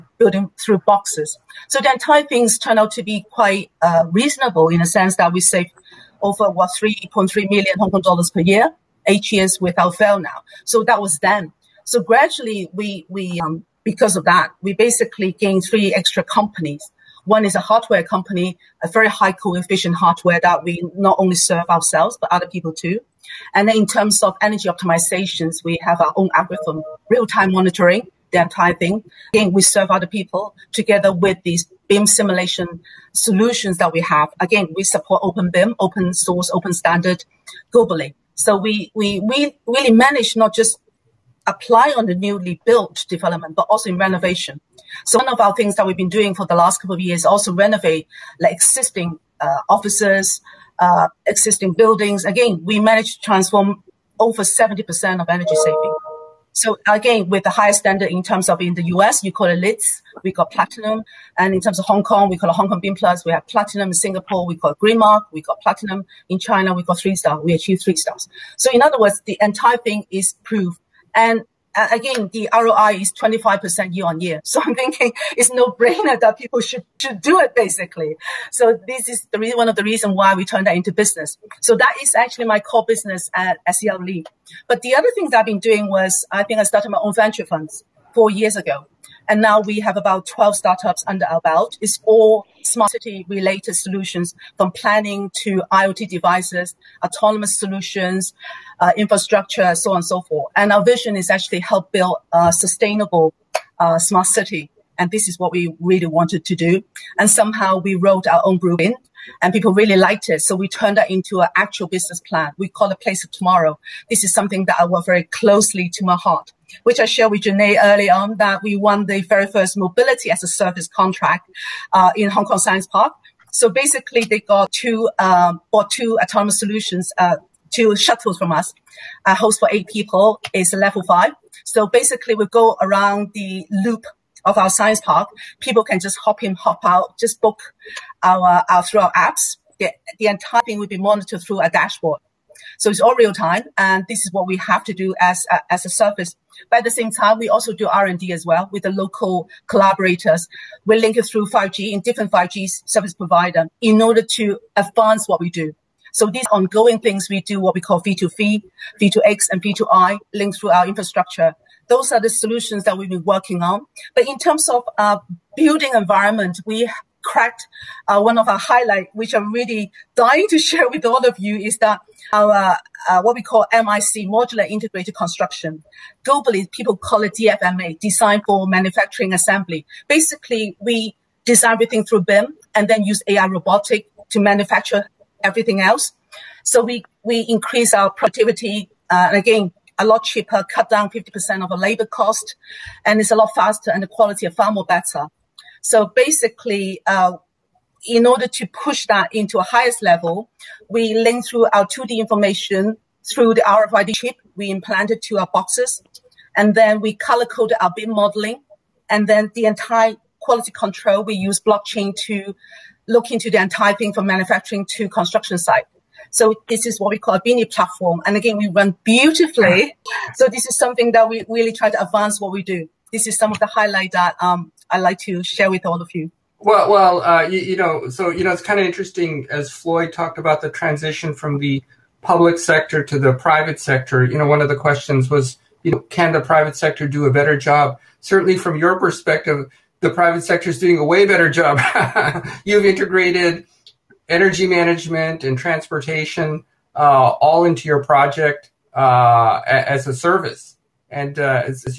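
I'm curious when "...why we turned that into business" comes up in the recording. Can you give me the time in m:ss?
1:20.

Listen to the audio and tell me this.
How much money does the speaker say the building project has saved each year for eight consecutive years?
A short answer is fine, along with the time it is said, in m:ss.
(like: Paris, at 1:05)
3.3 million Hong Kong dollars, at 0:06.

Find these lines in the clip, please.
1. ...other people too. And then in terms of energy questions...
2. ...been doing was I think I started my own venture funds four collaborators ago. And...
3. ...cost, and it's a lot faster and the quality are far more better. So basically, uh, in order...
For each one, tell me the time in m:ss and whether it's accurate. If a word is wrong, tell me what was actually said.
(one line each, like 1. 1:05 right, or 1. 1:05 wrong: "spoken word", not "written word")
1. 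0:22 wrong: "optimizations", not "questions"
2. 1:25 wrong: "years", not "collaborators"
3. 3:12 right.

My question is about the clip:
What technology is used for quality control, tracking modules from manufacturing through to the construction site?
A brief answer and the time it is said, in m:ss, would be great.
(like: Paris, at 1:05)
Blockchain, at 3:31.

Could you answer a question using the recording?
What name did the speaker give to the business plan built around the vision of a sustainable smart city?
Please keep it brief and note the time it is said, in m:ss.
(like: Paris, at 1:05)
Place of Tomorrow, at 1:52.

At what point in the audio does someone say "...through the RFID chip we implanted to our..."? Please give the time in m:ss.
3:23.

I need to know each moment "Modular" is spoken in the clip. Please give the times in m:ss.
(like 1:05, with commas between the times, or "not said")
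2:54.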